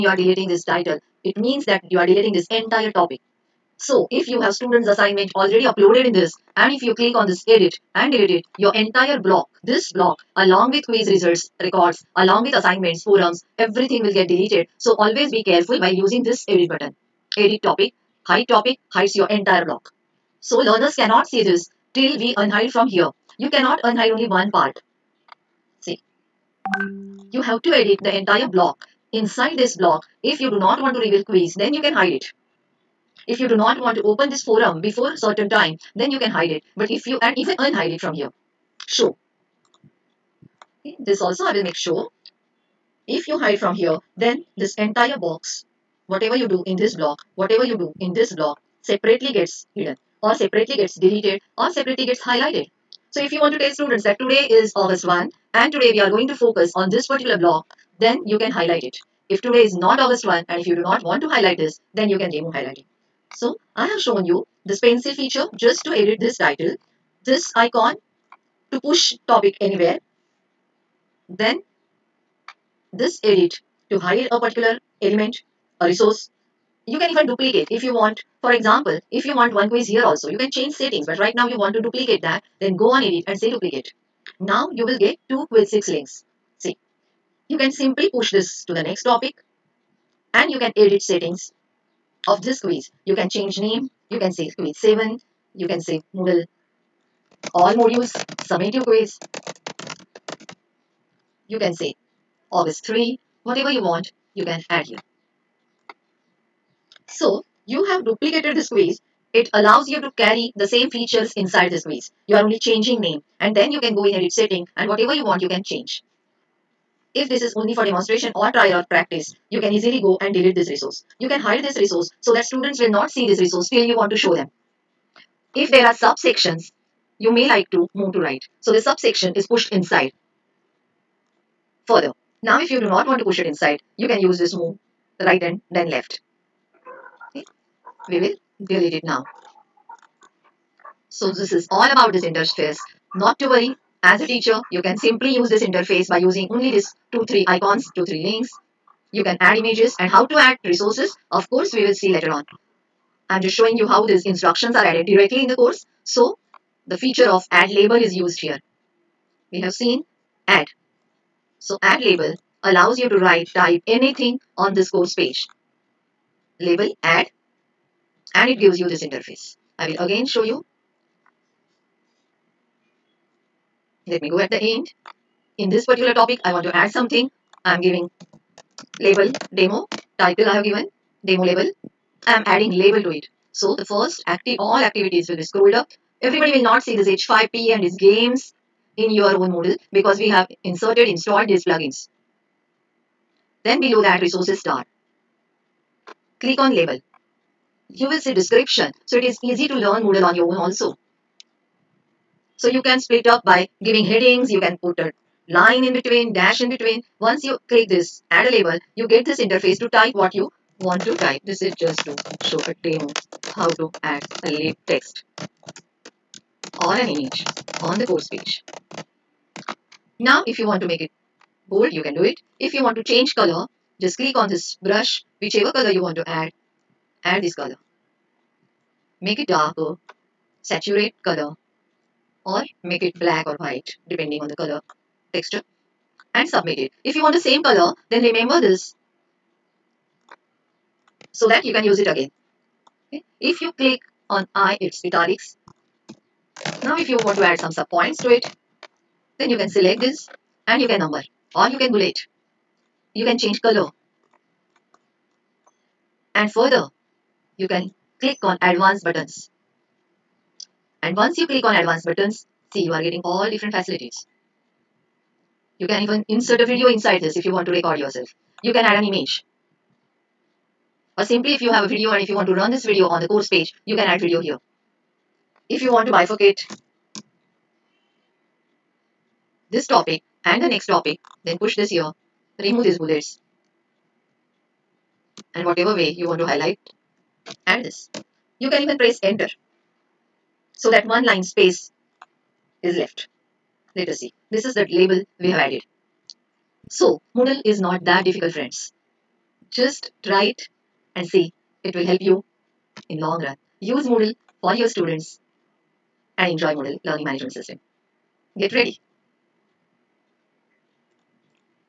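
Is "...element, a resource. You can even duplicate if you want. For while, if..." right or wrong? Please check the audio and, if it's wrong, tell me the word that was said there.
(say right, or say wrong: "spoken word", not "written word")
wrong: "example", not "while".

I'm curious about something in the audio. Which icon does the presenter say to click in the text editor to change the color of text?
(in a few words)
brush.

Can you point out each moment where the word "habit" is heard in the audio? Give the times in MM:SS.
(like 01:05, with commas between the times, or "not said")
not said.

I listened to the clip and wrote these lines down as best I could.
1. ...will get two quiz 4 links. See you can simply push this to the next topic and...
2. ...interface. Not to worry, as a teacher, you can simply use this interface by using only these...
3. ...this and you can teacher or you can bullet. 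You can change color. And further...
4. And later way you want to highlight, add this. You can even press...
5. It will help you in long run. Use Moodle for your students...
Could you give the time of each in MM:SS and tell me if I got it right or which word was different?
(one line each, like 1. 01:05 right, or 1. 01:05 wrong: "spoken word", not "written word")
1. 01:24 wrong: "6", not "4"
2. 02:22 right
3. 04:09 wrong: "number", not "teacher"
4. 04:45 wrong: "whatever", not "later"
5. 05:01 right.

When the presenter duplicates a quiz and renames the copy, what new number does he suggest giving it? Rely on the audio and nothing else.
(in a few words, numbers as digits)
Quiz 7.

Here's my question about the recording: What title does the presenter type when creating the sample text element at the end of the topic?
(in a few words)
demo label.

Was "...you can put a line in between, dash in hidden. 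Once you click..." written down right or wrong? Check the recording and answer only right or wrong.
wrong.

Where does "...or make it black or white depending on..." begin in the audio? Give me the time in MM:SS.
03:52.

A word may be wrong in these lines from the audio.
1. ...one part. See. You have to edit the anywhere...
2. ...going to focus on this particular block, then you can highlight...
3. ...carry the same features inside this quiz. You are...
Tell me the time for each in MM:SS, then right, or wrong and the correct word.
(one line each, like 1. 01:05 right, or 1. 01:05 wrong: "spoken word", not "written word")
1. 00:24 wrong: "entire", not "anywhere"
2. 00:56 right
3. 01:50 right.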